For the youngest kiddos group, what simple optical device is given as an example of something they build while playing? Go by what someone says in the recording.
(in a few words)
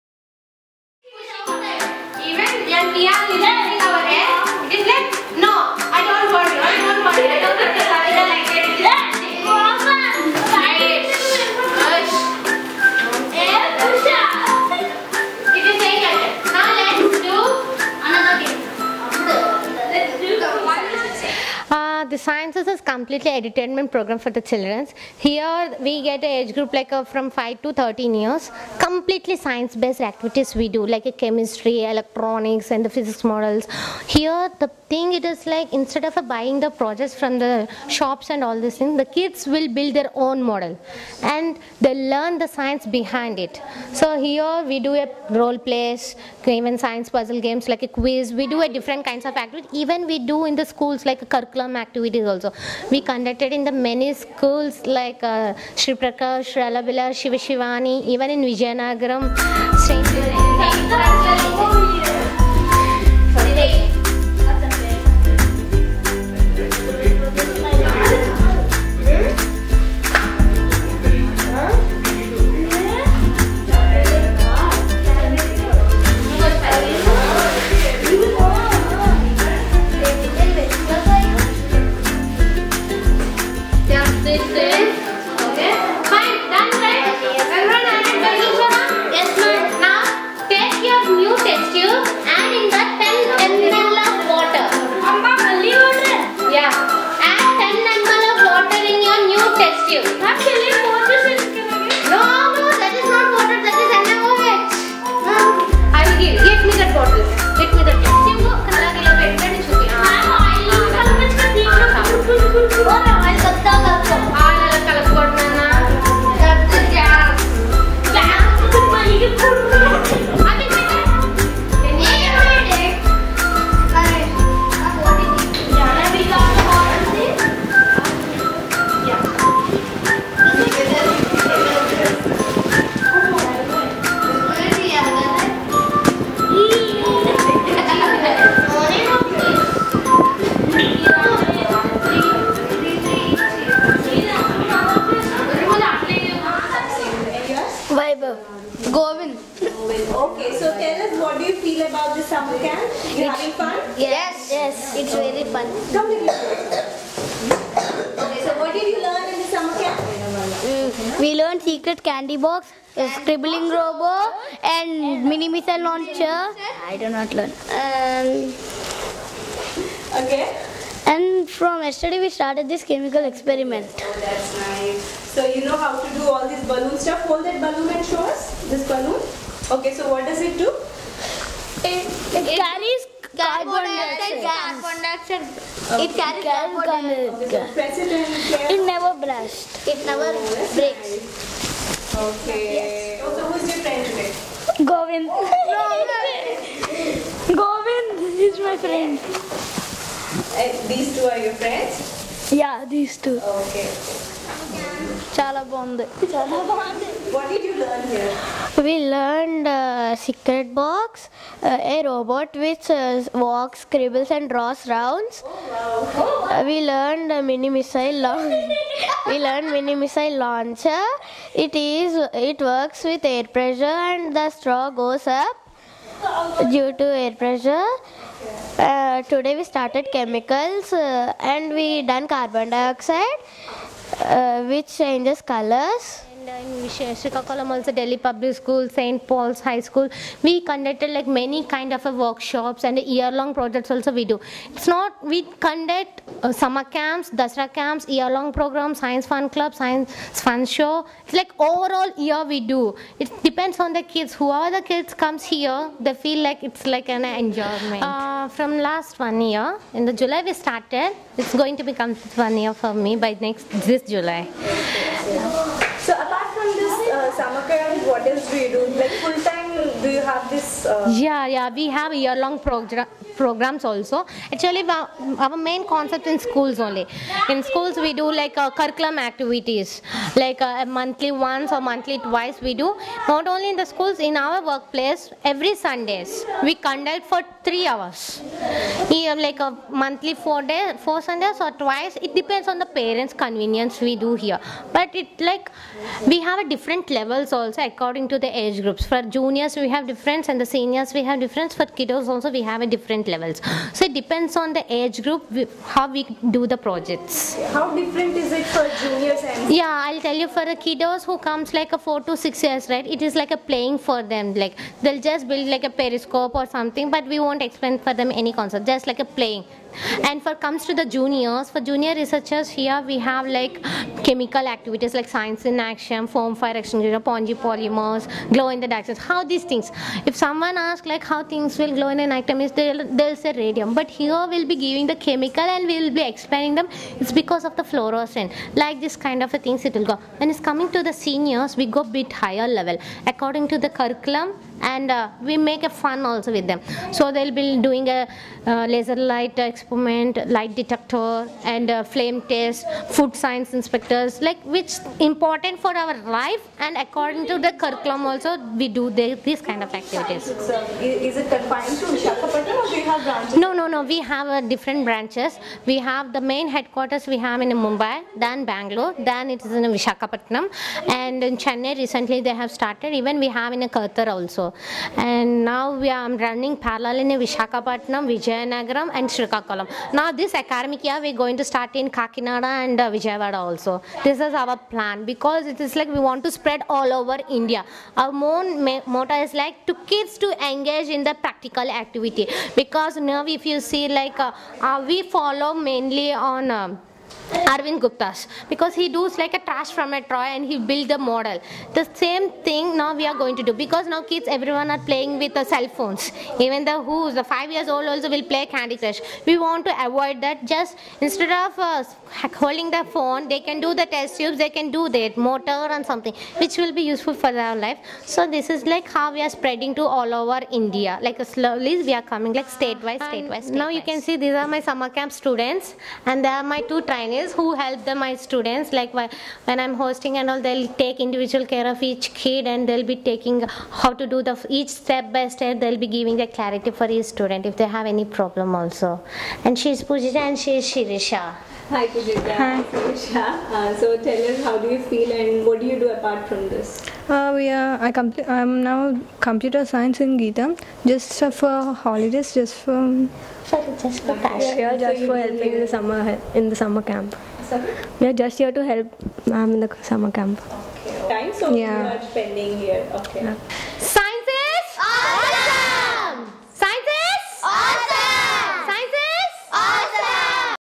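A periscope.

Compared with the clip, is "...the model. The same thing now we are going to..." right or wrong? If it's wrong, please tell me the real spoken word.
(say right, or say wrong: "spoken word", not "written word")
right.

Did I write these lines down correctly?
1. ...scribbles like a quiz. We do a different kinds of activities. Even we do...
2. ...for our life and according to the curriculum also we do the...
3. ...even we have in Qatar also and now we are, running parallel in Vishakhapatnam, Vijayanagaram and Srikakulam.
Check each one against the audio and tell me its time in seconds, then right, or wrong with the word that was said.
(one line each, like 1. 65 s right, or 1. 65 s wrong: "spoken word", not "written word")
1. 47 s wrong: "games", not "scribbles"
2. 355 s right
3. 373 s right.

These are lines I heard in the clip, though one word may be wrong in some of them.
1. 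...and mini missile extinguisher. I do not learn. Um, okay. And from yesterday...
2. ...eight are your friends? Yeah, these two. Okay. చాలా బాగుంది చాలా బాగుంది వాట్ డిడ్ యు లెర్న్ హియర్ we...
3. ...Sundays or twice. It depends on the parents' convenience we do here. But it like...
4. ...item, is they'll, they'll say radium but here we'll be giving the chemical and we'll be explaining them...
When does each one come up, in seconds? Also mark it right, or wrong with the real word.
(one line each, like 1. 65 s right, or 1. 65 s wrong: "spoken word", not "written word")
1. 164 s wrong: "launcher", not "extinguisher"
2. 201 s wrong: "two", not "eight"
3. 291 s right
4. 332 s right.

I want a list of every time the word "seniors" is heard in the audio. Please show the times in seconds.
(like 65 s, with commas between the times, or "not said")
300 s, 341 s.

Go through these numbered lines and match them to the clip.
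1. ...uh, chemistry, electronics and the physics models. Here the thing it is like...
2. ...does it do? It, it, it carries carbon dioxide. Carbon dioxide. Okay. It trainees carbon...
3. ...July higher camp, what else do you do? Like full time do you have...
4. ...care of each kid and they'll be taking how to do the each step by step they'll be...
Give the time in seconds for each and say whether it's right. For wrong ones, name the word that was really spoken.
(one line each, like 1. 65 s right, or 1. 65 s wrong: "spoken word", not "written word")
1. 31 s right
2. 180 s wrong: "carries", not "trainees"
3. 264 s wrong: "summer", not "higher"
4. 431 s right.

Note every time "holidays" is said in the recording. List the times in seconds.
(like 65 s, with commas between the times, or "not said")
451 s.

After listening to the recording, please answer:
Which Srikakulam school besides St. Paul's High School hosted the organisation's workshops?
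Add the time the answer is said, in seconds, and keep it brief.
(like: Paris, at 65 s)
Delhi Public School, at 237 s.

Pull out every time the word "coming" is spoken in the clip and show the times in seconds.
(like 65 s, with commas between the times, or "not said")
340 s, 422 s.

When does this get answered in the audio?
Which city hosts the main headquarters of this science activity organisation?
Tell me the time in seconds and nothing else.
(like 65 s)
367 s.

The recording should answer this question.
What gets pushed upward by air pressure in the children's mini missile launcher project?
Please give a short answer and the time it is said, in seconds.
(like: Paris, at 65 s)
The straw, at 224 s.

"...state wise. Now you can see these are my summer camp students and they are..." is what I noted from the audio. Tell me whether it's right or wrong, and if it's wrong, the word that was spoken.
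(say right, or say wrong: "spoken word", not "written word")
right.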